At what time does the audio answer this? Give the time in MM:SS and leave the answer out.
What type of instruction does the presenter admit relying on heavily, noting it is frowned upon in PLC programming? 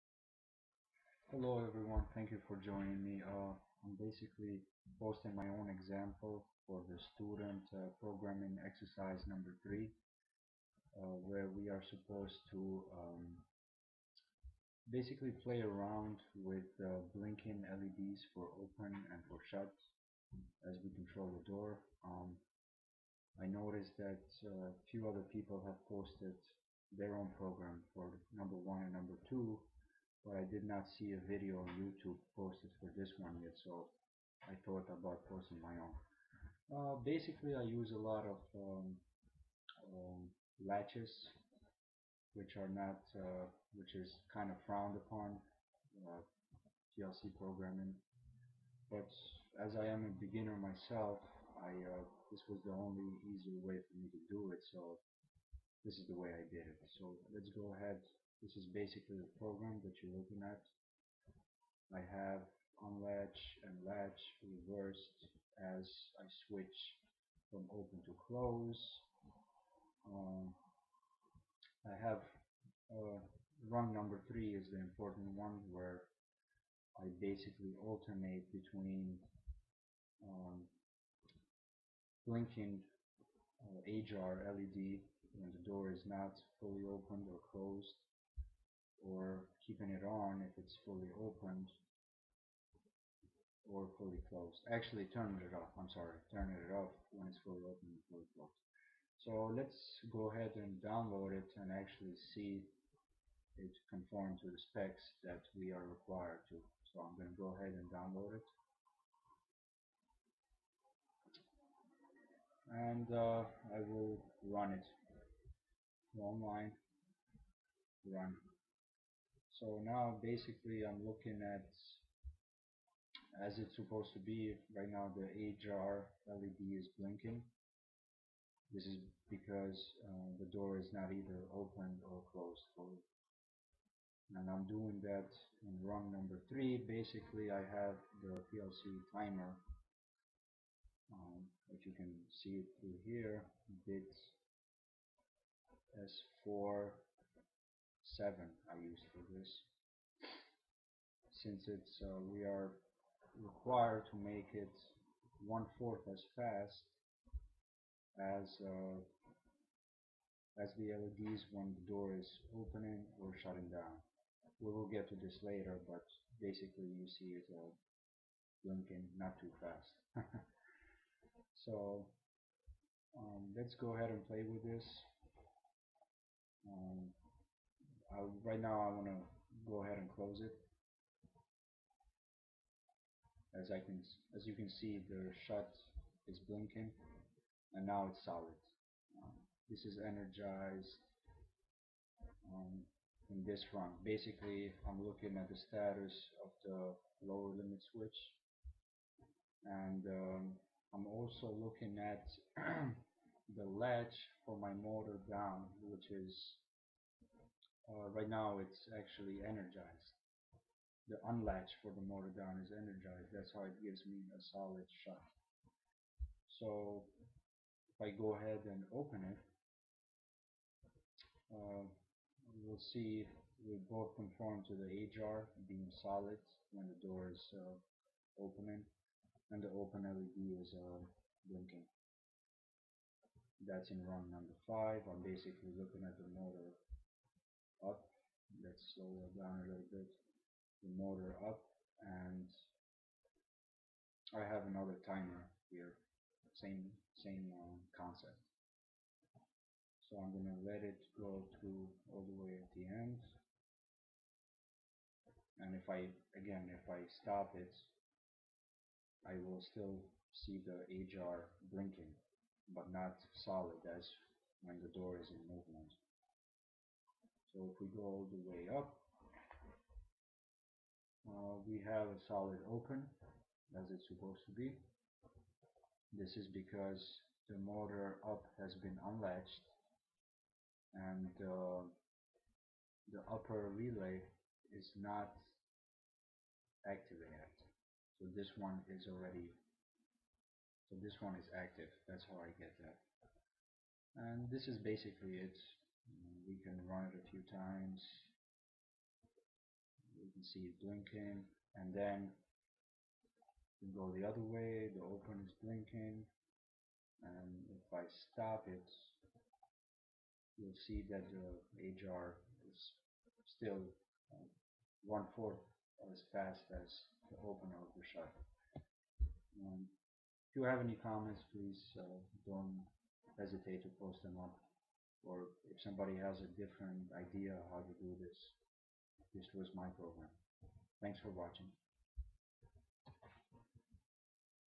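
00:40.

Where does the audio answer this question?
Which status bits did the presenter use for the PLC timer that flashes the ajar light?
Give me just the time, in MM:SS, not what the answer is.
02:25.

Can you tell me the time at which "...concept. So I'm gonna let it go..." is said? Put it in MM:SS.
04:07.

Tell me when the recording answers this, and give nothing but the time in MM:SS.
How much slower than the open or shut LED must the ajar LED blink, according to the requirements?
02:35.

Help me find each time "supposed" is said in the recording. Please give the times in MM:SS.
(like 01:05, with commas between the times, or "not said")
00:11, 02:03, 04:34.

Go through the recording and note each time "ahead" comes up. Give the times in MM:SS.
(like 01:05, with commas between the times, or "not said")
00:57, 01:40, 01:47, 02:53, 02:59, 03:38.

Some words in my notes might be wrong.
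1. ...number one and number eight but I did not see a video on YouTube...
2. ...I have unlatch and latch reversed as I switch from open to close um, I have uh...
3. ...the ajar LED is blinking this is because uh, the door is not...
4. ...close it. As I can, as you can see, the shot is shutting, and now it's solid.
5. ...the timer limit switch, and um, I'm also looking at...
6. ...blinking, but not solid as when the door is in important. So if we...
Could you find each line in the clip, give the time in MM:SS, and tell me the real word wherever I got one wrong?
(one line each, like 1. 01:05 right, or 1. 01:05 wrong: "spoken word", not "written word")
1. 00:28 wrong: "two", not "eight"
2. 01:01 right
3. 02:05 right
4. 03:00 wrong: "blinking", not "shutting"
5. 03:16 wrong: "lower", not "timer"
6. 04:21 wrong: "movement", not "important".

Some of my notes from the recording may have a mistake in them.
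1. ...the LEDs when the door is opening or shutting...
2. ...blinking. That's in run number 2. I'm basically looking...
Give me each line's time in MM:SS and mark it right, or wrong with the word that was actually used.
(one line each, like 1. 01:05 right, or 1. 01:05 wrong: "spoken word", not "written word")
1. 02:40 right
2. 03:51 wrong: "5", not "2".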